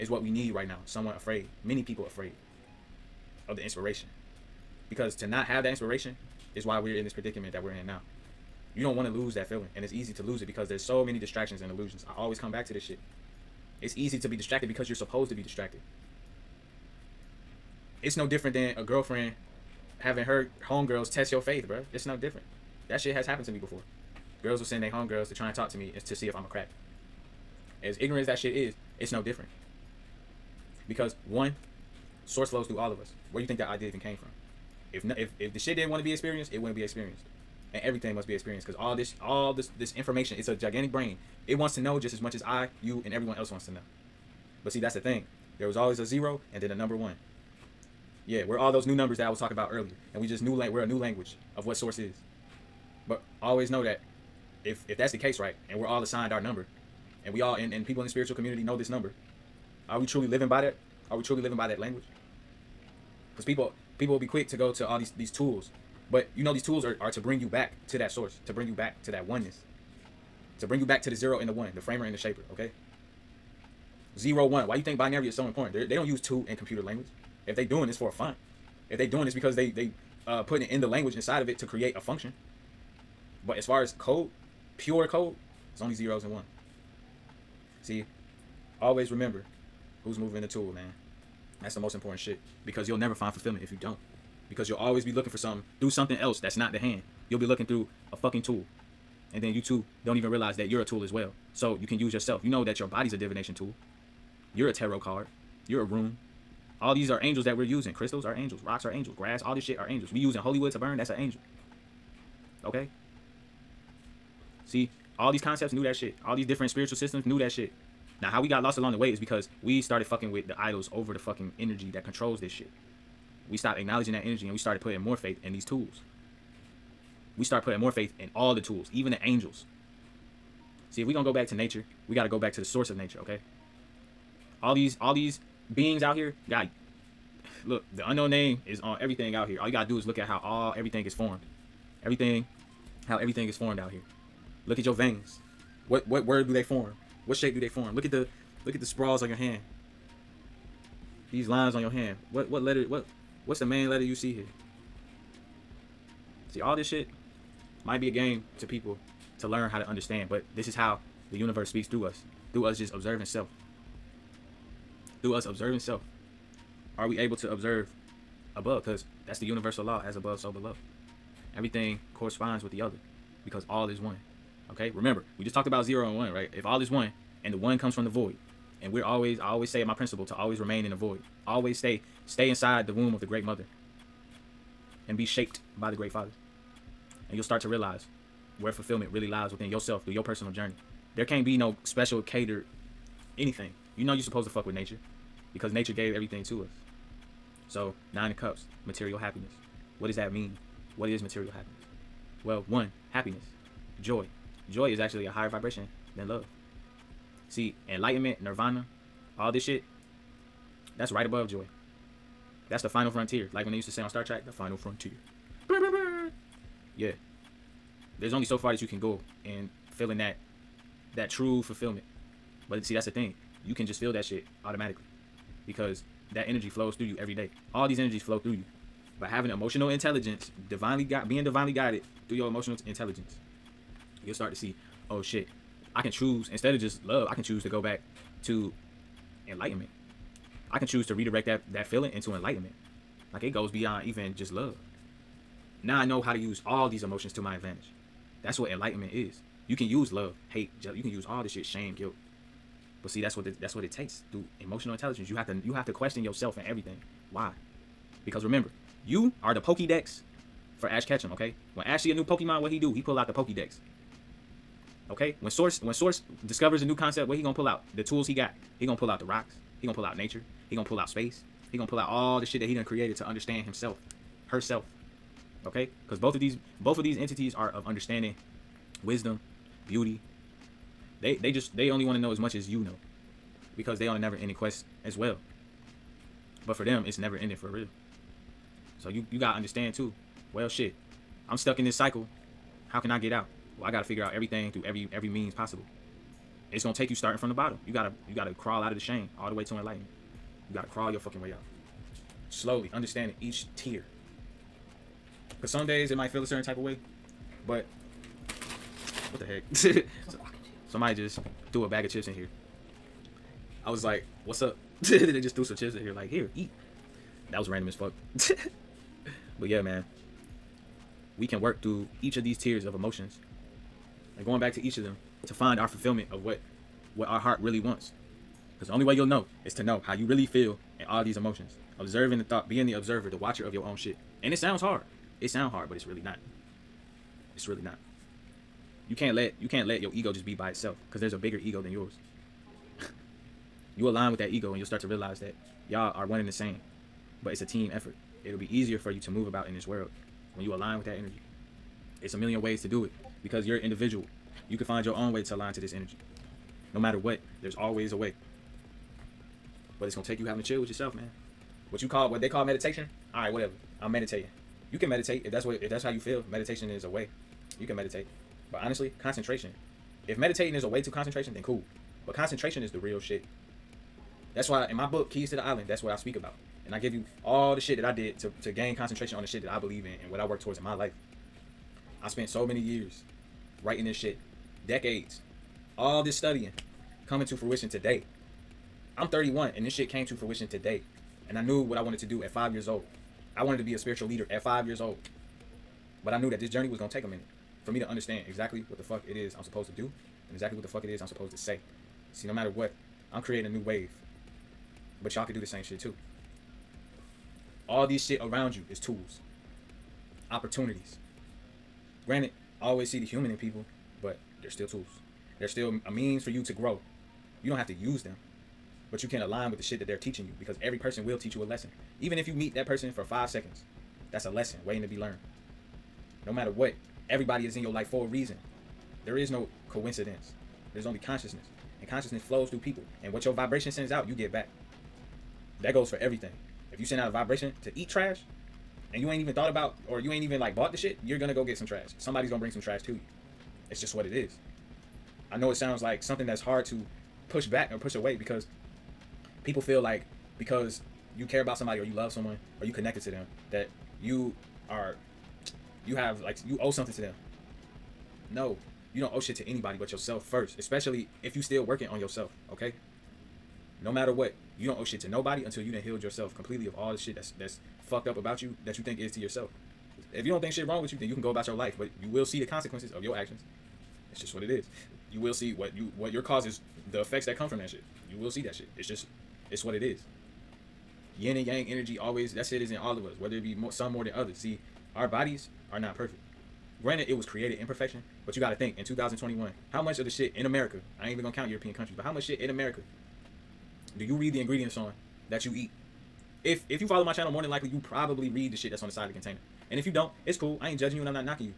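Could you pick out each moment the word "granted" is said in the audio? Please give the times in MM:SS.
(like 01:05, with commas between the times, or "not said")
06:52, 08:07.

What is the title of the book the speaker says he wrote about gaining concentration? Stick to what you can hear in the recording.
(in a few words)
Keys to the Island.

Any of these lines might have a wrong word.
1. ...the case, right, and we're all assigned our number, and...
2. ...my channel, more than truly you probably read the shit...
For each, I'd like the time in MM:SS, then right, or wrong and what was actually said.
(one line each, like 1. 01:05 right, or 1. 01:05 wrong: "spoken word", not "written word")
1. 00:55 right
2. 08:17 wrong: "likely", not "truly".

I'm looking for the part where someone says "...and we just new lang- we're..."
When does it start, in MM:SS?
00:50.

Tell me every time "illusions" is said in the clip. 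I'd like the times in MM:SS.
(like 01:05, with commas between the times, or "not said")
00:11.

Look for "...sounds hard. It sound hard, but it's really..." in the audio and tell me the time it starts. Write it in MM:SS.
05:34.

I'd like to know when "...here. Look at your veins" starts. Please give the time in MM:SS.
02:23.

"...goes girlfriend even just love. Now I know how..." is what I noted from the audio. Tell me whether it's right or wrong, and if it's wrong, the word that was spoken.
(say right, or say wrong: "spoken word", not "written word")
wrong: "beyond", not "girlfriend".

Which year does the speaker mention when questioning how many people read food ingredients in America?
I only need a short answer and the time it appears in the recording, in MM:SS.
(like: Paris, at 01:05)
2021, at 08:09.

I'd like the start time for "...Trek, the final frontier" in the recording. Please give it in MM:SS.
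03:34.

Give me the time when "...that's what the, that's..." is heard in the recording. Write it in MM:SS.
04:13.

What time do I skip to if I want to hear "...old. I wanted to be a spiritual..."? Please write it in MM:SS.
06:32.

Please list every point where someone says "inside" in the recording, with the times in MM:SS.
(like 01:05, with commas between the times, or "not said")
01:21, 03:02.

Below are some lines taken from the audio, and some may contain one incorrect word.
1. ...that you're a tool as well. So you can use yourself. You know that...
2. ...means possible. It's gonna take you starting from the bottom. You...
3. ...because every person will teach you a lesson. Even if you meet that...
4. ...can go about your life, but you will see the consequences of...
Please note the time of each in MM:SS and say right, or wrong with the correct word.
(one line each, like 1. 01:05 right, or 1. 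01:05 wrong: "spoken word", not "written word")
1. 01:40 right
2. 04:55 right
3. 07:00 right
4. 07:51 right.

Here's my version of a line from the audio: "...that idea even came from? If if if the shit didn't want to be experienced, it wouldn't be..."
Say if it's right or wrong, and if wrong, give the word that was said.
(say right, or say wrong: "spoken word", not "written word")
right.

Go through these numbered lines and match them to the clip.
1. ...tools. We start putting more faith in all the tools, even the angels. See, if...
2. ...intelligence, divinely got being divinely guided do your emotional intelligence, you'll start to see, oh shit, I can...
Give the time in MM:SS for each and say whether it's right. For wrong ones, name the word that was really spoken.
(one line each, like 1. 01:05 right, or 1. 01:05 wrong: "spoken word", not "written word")
1. 02:05 right
2. 03:49 right.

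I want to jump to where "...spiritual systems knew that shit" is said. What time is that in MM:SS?
01:56.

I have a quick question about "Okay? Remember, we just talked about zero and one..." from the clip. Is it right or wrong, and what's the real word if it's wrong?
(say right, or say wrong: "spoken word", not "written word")
right.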